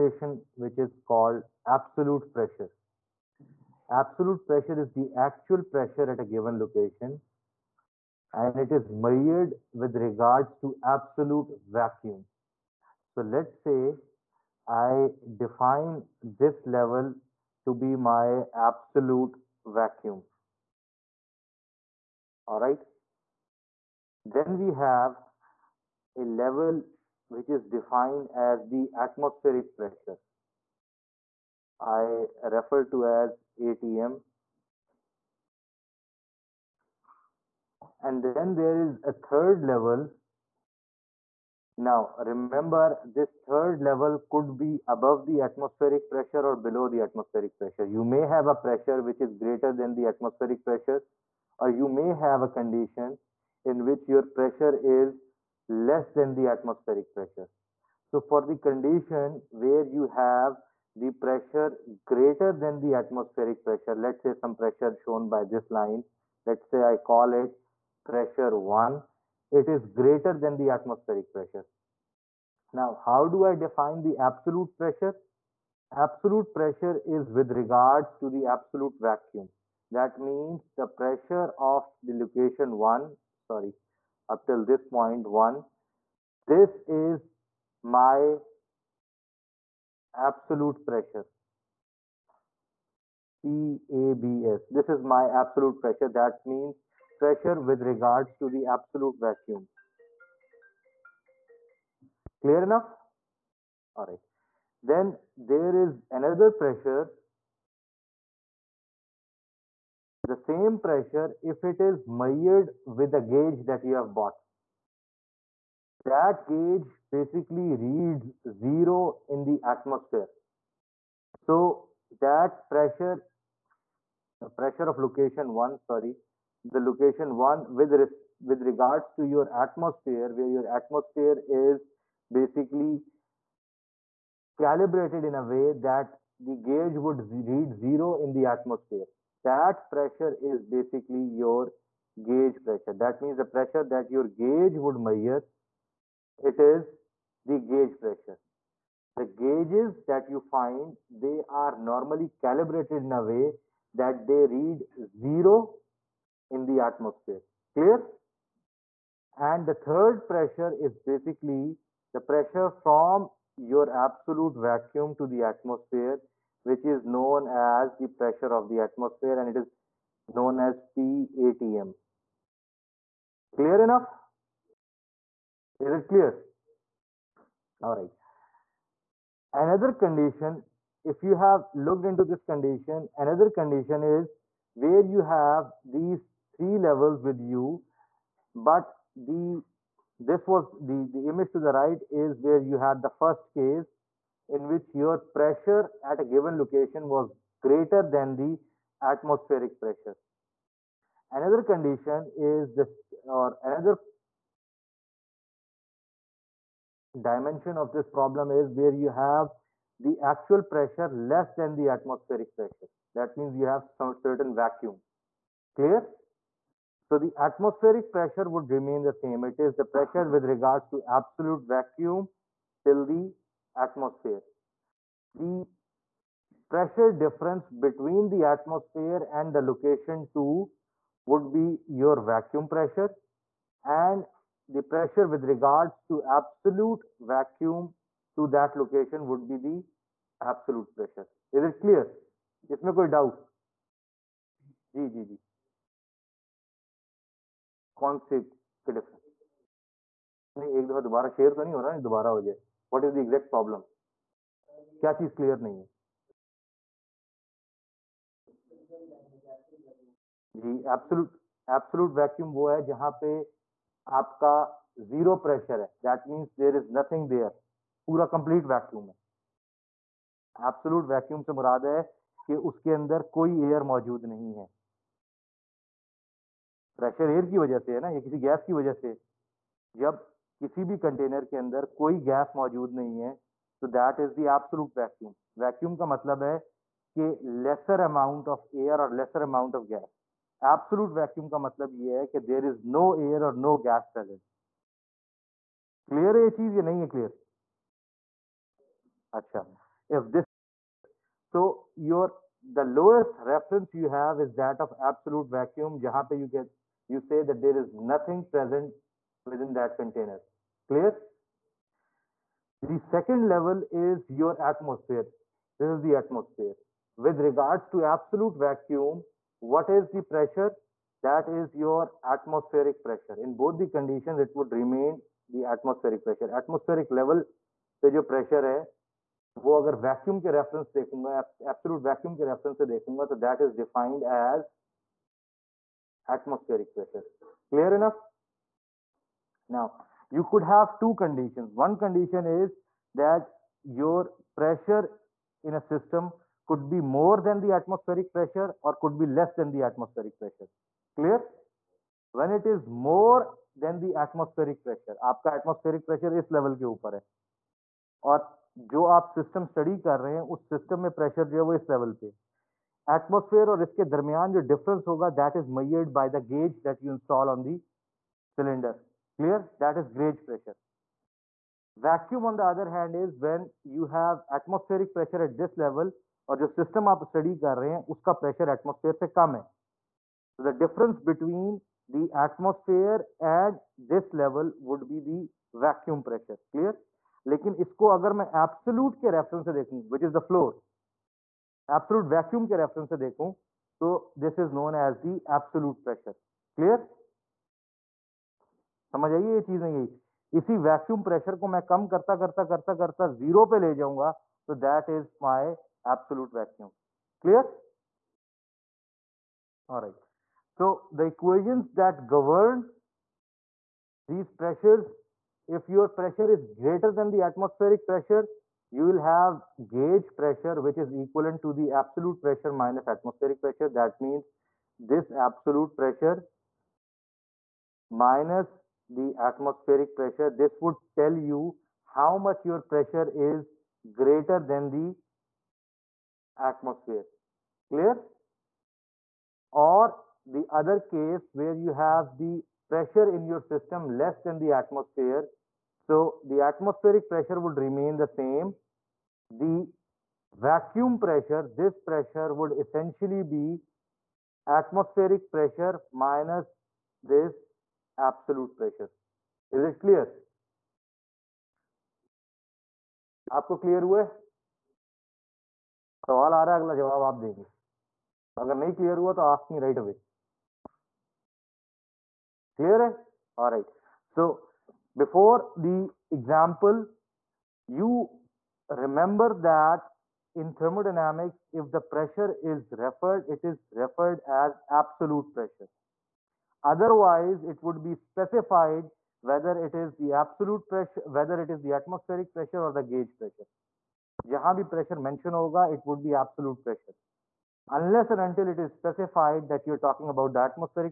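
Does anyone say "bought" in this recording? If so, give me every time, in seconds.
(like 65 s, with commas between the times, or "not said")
114 s.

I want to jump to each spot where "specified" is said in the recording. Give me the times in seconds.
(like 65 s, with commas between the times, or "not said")
488 s, 498 s.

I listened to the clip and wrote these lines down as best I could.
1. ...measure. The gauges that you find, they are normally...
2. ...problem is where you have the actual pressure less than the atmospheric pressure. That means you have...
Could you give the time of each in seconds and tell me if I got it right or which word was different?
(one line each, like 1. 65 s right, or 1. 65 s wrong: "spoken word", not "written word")
1. 147 s wrong: "pressure", not "measure"
2. 208 s right.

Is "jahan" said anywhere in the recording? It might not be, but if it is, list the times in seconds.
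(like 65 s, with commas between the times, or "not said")
305 s, 494 s.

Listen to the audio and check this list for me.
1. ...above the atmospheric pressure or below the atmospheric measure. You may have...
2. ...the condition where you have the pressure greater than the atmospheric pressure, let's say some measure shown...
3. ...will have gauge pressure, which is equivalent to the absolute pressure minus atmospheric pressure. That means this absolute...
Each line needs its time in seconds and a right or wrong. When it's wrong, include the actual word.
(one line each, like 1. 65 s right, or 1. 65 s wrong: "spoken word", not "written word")
1. 44 s wrong: "pressure", not "measure"
2. 58 s wrong: "pressure", not "measure"
3. 419 s right.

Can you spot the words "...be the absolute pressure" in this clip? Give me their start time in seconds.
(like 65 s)
239 s.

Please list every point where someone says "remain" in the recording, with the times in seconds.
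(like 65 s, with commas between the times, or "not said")
218 s, 324 s, 447 s.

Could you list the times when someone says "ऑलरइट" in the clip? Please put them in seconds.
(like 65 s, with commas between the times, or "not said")
409 s.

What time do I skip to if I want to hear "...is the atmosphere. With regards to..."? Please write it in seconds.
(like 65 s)
315 s.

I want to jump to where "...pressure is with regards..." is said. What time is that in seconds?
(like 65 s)
76 s.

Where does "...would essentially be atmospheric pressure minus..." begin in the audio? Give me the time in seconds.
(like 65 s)
452 s.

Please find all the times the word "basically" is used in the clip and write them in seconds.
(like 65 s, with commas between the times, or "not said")
117 s, 132 s, 140 s, 160 s.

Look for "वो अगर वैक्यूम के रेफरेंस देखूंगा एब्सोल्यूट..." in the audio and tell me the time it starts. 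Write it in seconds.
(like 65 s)
329 s.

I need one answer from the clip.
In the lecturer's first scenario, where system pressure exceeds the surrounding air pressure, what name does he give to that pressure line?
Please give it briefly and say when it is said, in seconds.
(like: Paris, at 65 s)
pressure one, at 68 s.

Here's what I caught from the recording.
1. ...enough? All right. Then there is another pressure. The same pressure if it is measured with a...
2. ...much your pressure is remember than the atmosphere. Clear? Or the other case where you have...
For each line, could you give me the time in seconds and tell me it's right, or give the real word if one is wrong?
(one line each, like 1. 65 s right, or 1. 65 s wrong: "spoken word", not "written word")
1. 102 s right
2. 432 s wrong: "greater", not "remember".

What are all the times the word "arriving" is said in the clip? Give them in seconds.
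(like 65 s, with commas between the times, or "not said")
not said.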